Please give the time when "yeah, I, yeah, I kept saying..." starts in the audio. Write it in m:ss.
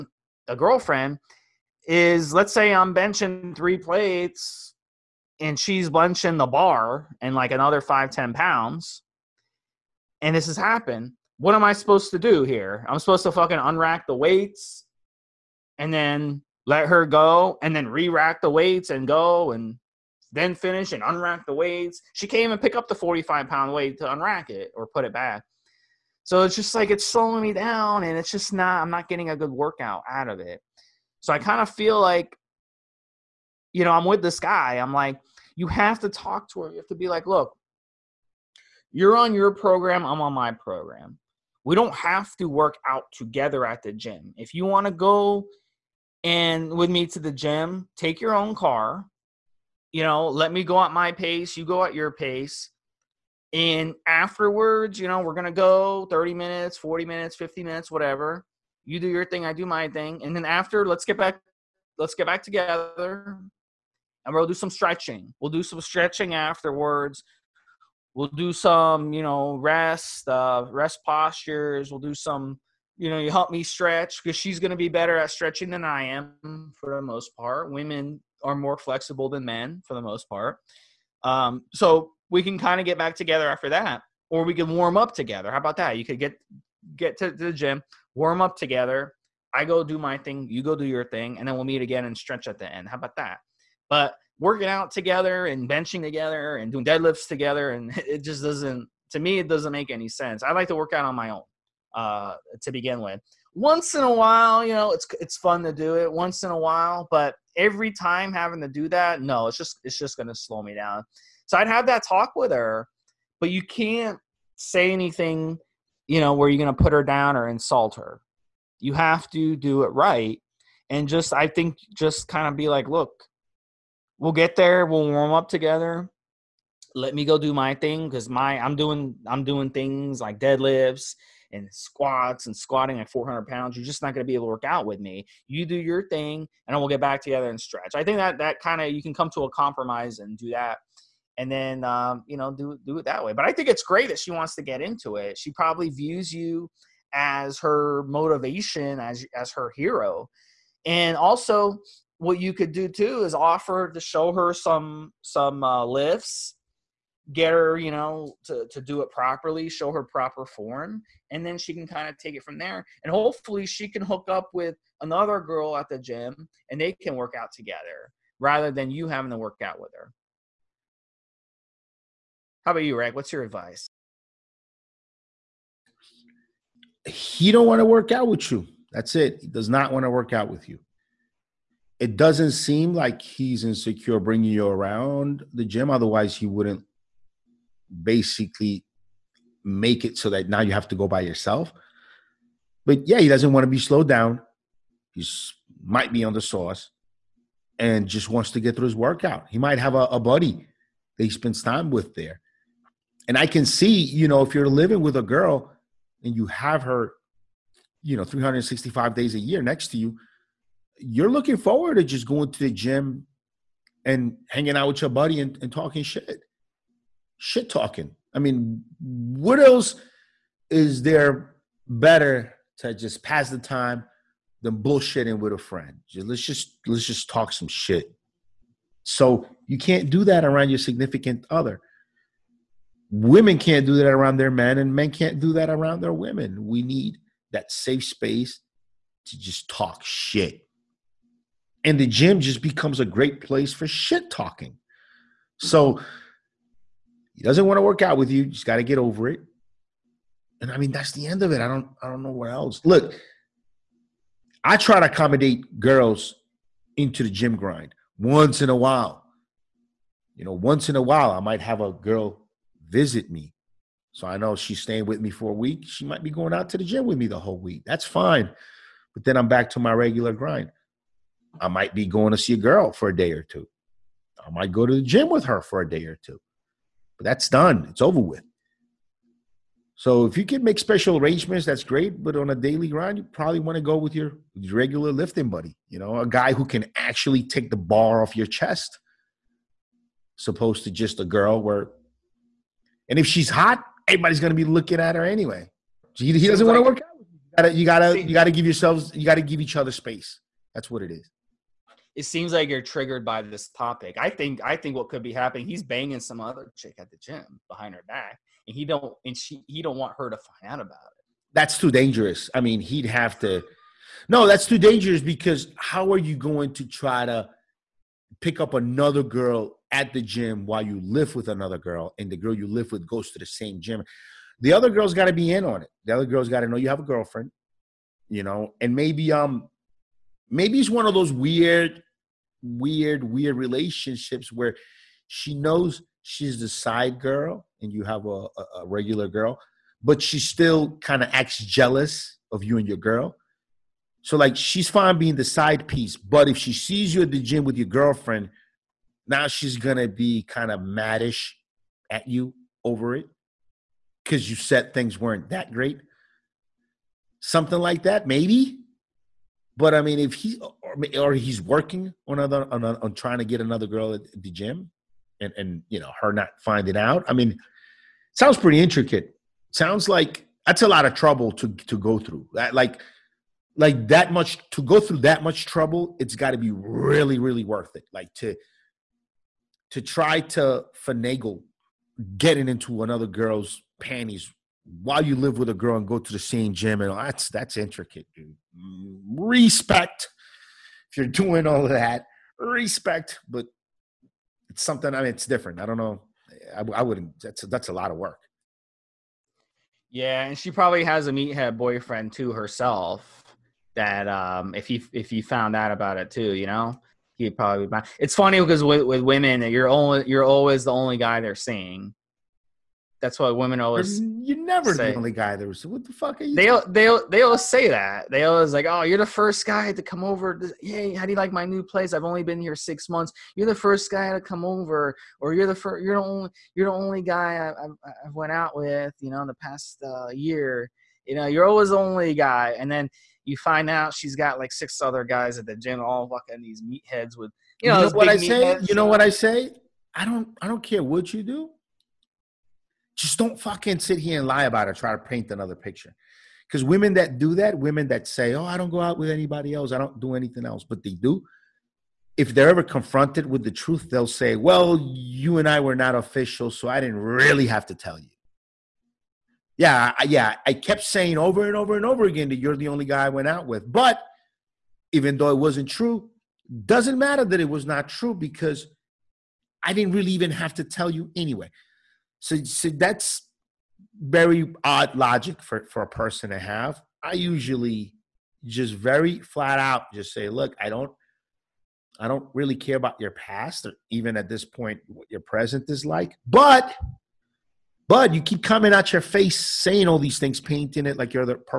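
7:39.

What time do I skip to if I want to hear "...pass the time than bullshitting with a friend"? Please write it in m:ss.
3:43.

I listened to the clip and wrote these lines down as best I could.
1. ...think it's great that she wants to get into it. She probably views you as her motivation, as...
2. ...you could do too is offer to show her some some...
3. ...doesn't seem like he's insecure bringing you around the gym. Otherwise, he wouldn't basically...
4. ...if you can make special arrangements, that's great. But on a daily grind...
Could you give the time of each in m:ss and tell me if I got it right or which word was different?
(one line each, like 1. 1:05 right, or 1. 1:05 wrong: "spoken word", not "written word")
1. 2:23 right
2. 2:32 right
3. 3:02 right
4. 4:40 right.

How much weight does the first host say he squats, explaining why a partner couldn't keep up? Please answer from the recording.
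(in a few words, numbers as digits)
400 pounds.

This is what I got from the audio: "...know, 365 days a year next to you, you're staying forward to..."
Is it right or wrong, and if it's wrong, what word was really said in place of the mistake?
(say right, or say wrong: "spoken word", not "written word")
wrong: "looking", not "staying".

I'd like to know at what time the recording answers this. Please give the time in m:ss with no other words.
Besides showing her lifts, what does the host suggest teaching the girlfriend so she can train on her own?
2:40.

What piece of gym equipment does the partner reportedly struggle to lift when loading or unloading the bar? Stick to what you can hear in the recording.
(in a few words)
45 pound weight.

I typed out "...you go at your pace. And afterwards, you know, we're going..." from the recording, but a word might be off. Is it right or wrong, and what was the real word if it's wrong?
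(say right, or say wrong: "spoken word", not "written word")
right.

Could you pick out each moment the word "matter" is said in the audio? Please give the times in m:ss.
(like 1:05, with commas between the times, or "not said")
7:47.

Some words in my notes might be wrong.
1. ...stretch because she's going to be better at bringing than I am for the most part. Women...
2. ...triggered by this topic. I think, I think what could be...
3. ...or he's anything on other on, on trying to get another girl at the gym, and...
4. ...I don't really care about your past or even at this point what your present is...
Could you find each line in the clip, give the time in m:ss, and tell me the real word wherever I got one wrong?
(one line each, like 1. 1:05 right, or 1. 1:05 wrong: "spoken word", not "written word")
1. 1:13 wrong: "stretching", not "bringing"
2. 5:02 right
3. 6:01 wrong: "working", not "anything"
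4. 8:02 right.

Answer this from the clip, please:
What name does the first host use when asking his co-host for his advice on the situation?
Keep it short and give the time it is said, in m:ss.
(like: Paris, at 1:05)
Rag, at 2:52.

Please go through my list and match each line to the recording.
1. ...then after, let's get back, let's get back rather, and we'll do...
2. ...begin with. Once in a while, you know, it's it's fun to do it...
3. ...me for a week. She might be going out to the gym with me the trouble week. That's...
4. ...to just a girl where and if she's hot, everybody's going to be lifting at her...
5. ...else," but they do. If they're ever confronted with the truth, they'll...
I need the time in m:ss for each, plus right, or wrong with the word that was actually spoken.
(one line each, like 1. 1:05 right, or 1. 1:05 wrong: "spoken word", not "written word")
1. 1:00 wrong: "together", not "rather"
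2. 1:42 right
3. 4:25 wrong: "whole", not "trouble"
4. 4:50 wrong: "looking", not "lifting"
5. 7:30 right.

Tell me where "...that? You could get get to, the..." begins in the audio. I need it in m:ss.
1:25.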